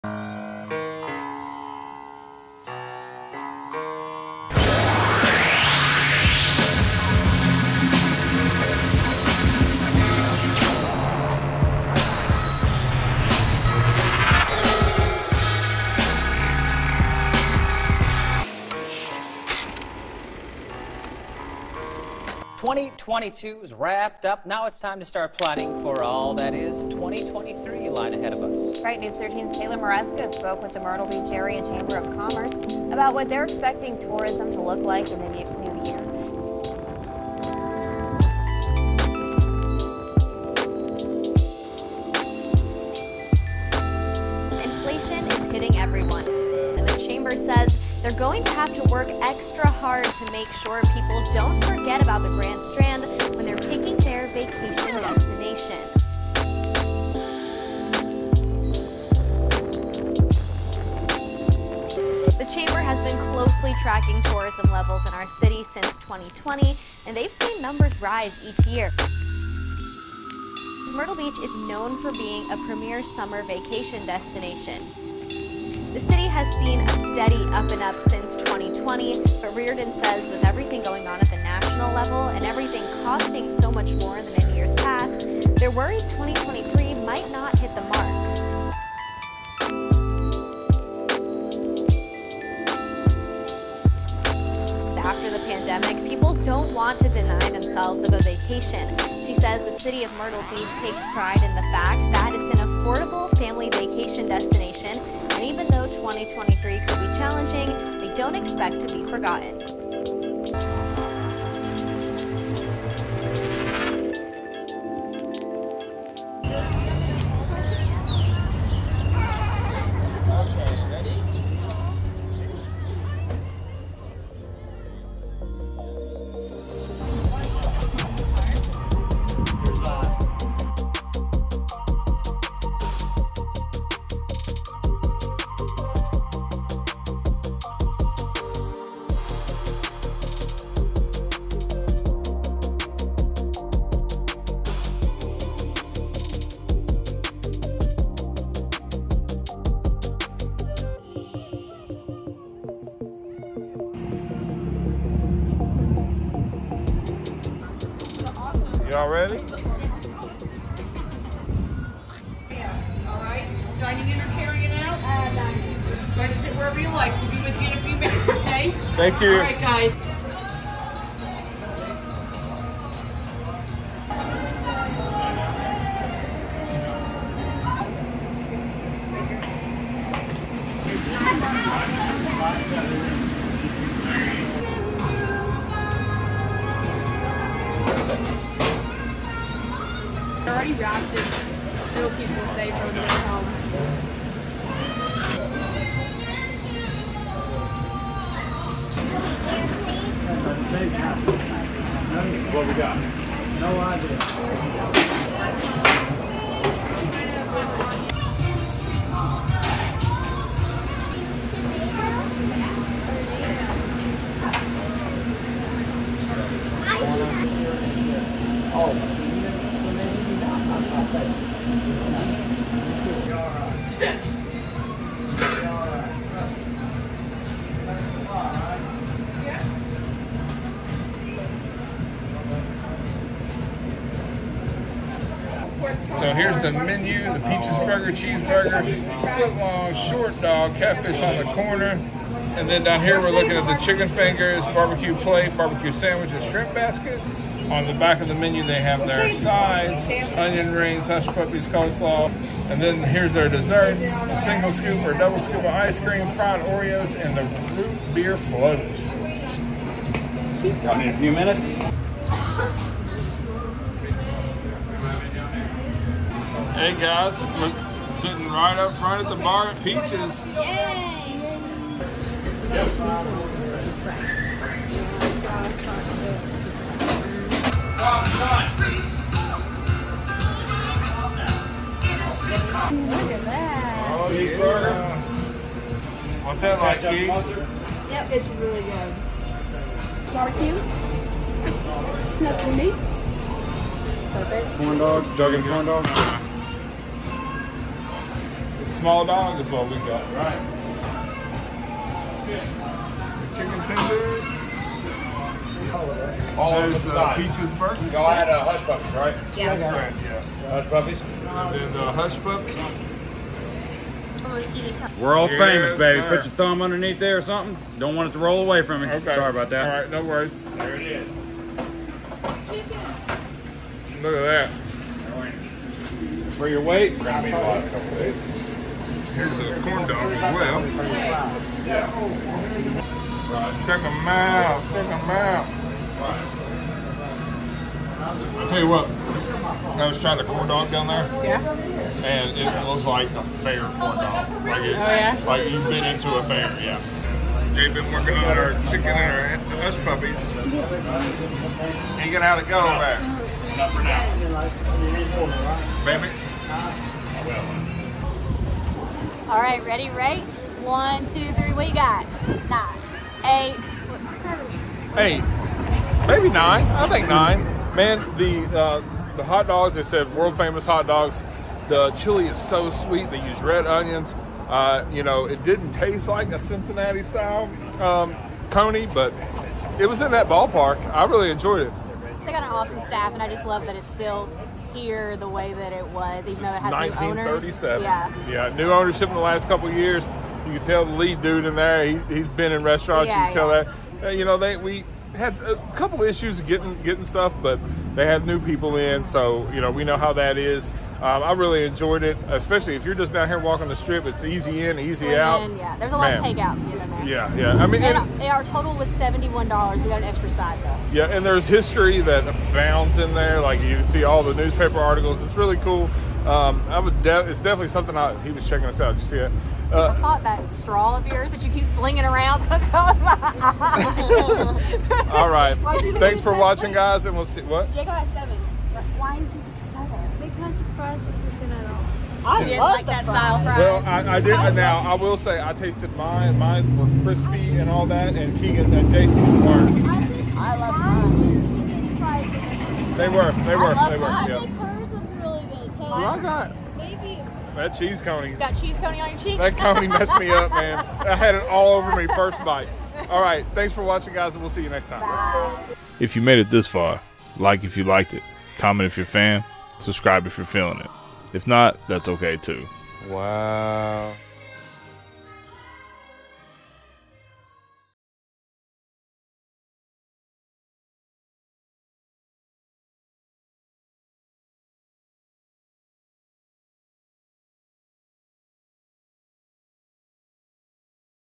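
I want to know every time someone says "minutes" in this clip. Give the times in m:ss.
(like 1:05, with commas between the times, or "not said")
2:47, 4:21.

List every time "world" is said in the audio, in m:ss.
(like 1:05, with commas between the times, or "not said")
5:15, 6:10.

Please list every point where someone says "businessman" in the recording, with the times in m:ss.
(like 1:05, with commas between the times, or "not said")
not said.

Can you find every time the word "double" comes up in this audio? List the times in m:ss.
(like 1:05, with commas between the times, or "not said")
4:15.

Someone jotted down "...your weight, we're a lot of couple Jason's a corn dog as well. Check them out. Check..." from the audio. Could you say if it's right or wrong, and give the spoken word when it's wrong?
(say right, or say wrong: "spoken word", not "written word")
wrong: "Here", not "Jason".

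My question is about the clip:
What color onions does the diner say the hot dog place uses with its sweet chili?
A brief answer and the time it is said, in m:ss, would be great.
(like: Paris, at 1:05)
Red, at 6:13.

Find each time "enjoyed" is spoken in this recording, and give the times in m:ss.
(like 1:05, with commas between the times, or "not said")
6:21, 6:41.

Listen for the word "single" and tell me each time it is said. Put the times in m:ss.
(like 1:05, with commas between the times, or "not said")
4:14.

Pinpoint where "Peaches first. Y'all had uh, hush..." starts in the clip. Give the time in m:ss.
5:07.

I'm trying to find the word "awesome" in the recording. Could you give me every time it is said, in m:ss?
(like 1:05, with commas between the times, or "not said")
6:22.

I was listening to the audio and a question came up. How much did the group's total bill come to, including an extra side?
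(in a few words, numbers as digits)
$71.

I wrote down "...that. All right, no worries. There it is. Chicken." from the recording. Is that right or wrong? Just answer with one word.
right.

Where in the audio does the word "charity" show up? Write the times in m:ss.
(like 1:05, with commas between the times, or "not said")
not said.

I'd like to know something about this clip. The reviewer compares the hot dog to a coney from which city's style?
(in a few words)
Cincinnati.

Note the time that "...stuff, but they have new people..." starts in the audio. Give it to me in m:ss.
6:37.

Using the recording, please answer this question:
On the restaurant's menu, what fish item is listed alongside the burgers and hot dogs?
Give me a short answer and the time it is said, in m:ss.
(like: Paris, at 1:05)
Catfish, at 4:00.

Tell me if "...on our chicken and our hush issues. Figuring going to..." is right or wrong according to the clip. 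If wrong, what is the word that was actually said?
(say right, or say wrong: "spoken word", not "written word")
wrong: "puppies", not "issues".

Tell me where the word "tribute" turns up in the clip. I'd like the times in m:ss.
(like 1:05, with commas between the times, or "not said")
not said.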